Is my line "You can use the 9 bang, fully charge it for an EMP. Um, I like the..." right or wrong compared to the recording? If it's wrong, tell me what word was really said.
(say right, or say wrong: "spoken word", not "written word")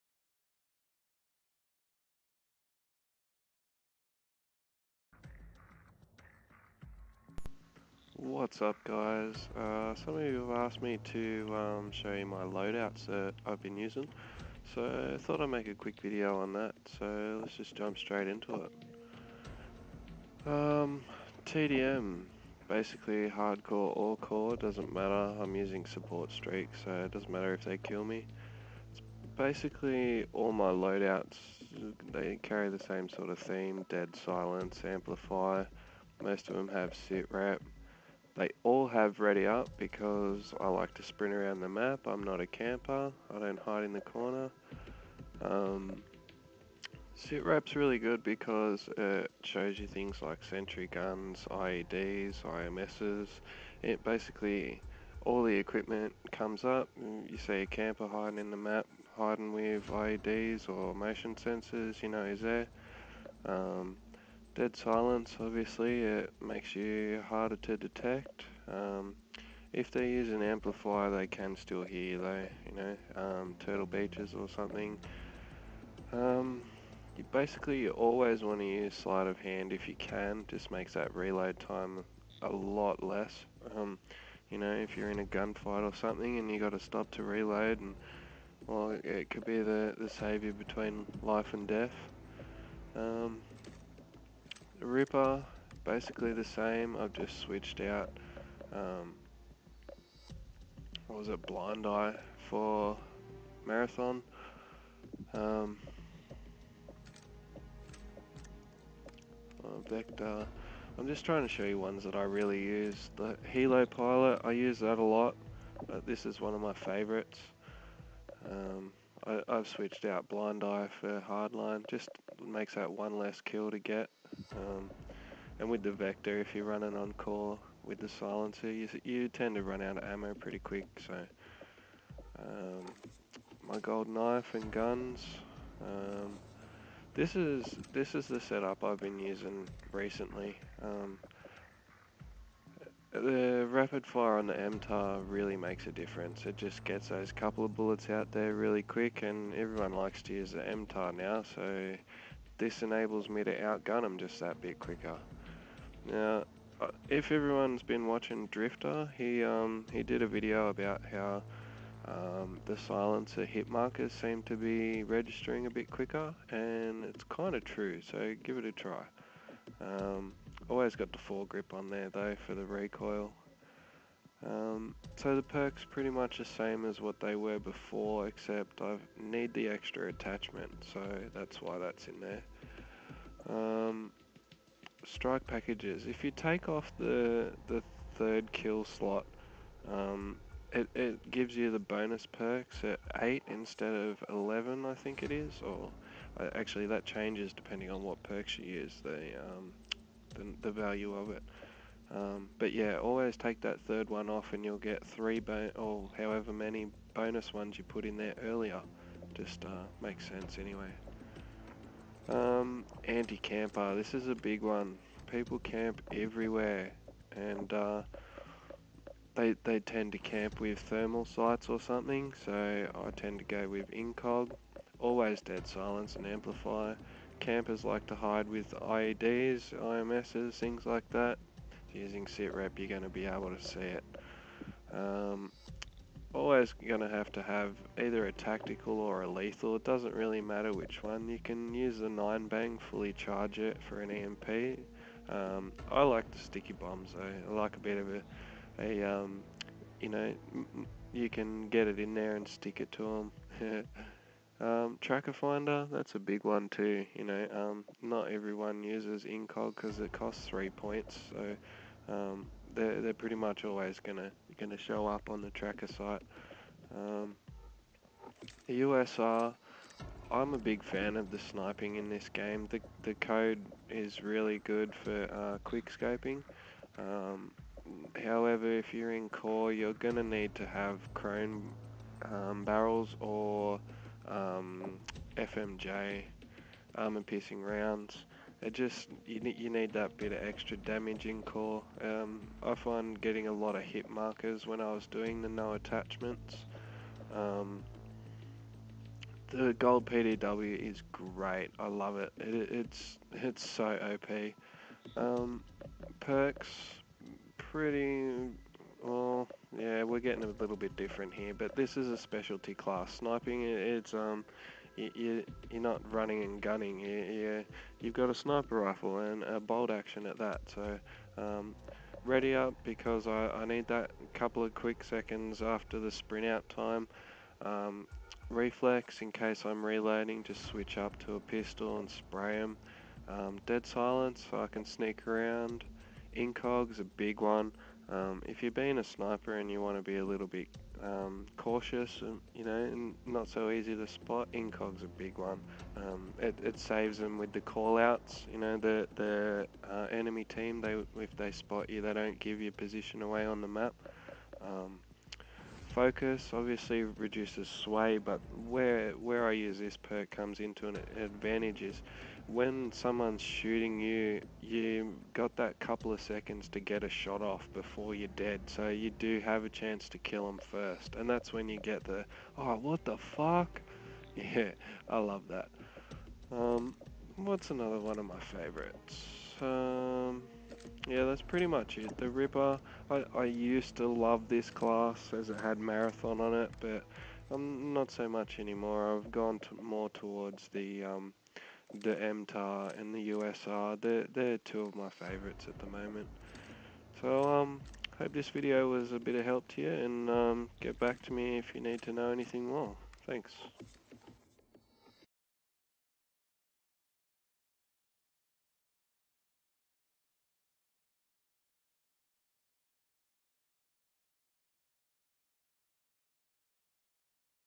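right.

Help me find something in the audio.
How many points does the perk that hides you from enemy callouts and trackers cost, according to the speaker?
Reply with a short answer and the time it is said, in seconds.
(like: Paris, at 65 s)
3, at 260 s.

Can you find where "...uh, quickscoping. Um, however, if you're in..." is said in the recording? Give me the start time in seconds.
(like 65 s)
275 s.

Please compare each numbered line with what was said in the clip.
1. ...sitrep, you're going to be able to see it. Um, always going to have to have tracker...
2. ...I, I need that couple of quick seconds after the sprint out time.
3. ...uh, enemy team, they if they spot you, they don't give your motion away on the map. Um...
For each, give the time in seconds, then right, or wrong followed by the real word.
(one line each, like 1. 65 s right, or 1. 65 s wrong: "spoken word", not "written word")
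1. 232 s wrong: "either", not "tracker"
2. 323 s right
3. 349 s wrong: "position", not "motion".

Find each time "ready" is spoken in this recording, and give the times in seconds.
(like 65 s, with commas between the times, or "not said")
39 s, 322 s.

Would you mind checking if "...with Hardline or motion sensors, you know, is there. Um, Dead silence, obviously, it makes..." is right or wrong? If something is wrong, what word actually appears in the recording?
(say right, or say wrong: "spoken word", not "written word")
wrong: "IEDs", not "Hardline".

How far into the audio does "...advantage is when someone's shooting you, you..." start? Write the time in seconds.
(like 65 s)
361 s.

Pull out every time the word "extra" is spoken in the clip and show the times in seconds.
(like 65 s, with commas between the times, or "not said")
179 s, 290 s.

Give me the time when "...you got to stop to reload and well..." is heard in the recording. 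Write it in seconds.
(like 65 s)
86 s.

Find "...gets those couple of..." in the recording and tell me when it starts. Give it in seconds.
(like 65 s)
146 s.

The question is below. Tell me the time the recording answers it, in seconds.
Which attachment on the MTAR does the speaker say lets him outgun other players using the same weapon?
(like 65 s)
143 s.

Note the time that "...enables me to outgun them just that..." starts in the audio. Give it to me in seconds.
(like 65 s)
152 s.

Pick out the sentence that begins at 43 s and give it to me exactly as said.
I don't hide in the corner.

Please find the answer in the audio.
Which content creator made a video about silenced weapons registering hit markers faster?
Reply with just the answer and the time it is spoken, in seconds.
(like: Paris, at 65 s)
Drifter, at 158 s.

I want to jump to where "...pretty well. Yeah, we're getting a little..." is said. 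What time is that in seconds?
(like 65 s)
307 s.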